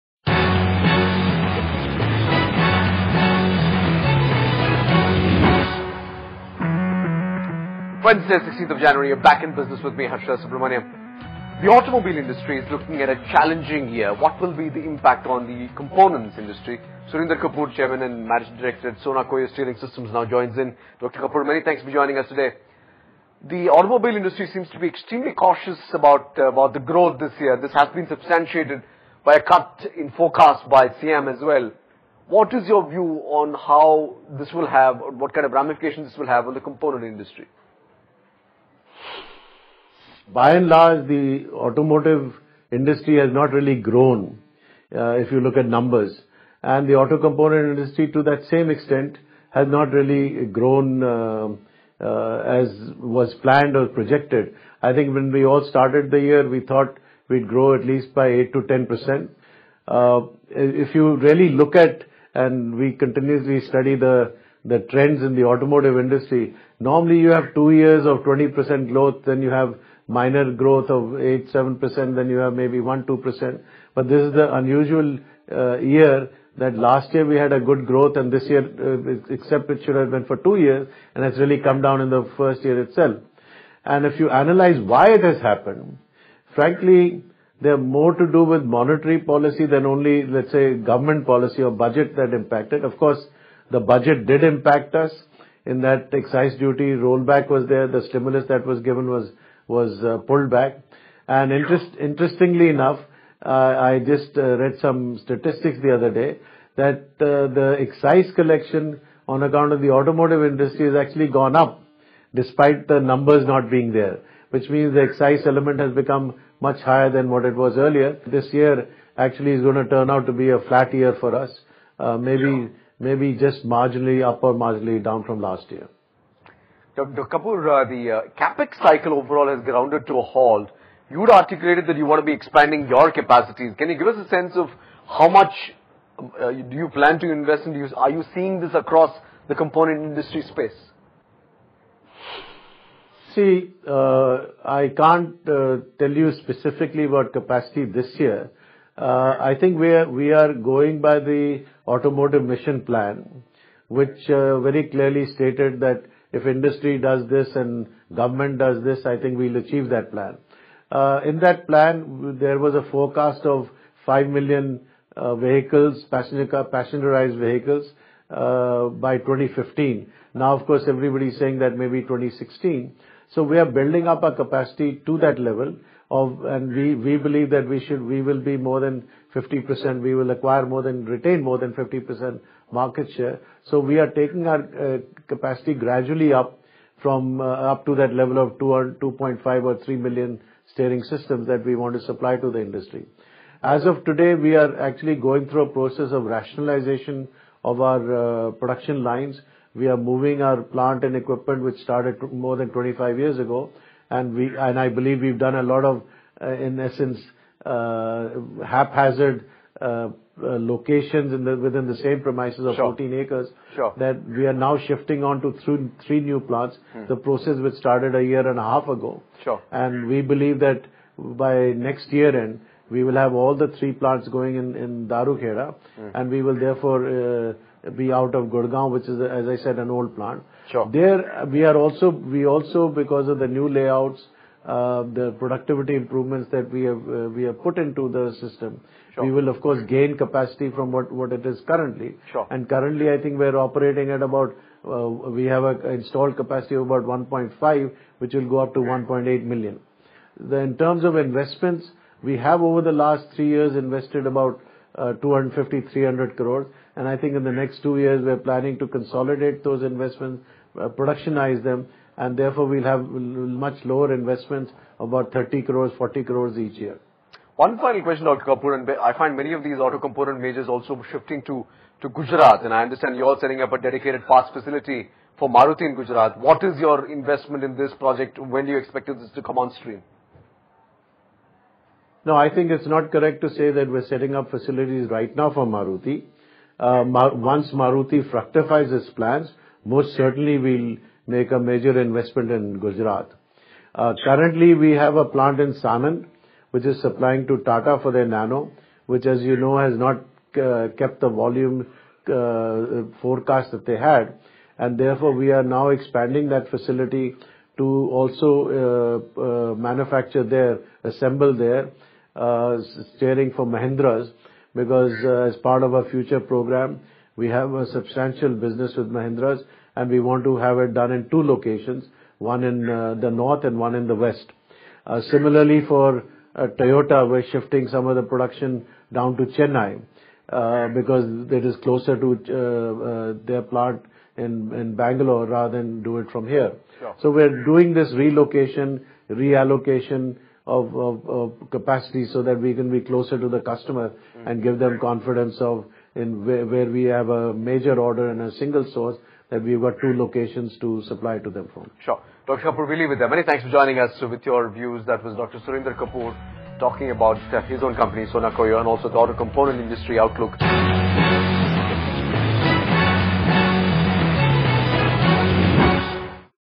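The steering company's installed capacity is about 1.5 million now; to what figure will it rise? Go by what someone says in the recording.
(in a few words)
1.8 million.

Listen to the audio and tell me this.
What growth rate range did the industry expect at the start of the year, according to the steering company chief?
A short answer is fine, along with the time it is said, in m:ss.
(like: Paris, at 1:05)
8 to 10 percent, at 0:58.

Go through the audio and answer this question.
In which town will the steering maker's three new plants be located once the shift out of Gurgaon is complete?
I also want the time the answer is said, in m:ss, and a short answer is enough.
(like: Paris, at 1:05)
Dharuhera, at 3:45.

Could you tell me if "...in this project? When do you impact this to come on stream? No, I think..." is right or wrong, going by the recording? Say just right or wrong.
wrong.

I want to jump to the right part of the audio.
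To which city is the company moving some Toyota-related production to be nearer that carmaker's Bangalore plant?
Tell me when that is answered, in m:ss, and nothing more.
5:29.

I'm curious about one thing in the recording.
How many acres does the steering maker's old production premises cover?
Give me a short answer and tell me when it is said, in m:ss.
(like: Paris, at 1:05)
14 acres, at 3:32.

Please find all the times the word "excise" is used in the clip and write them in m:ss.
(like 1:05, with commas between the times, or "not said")
1:36, 1:47, 1:55.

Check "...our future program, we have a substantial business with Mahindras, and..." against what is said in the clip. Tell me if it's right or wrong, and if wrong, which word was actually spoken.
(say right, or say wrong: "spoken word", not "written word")
right.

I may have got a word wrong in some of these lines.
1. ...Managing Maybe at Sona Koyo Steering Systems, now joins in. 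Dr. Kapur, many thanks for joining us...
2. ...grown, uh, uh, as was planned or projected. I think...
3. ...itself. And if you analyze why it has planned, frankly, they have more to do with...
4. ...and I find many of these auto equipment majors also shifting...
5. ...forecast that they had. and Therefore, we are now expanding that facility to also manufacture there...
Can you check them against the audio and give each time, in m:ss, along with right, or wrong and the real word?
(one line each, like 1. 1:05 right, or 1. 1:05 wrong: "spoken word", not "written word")
1. 0:18 wrong: "Director", not "Maybe"
2. 0:50 right
3. 1:22 wrong: "happened", not "planned"
4. 4:28 wrong: "component", not "equipment"
5. 5:03 right.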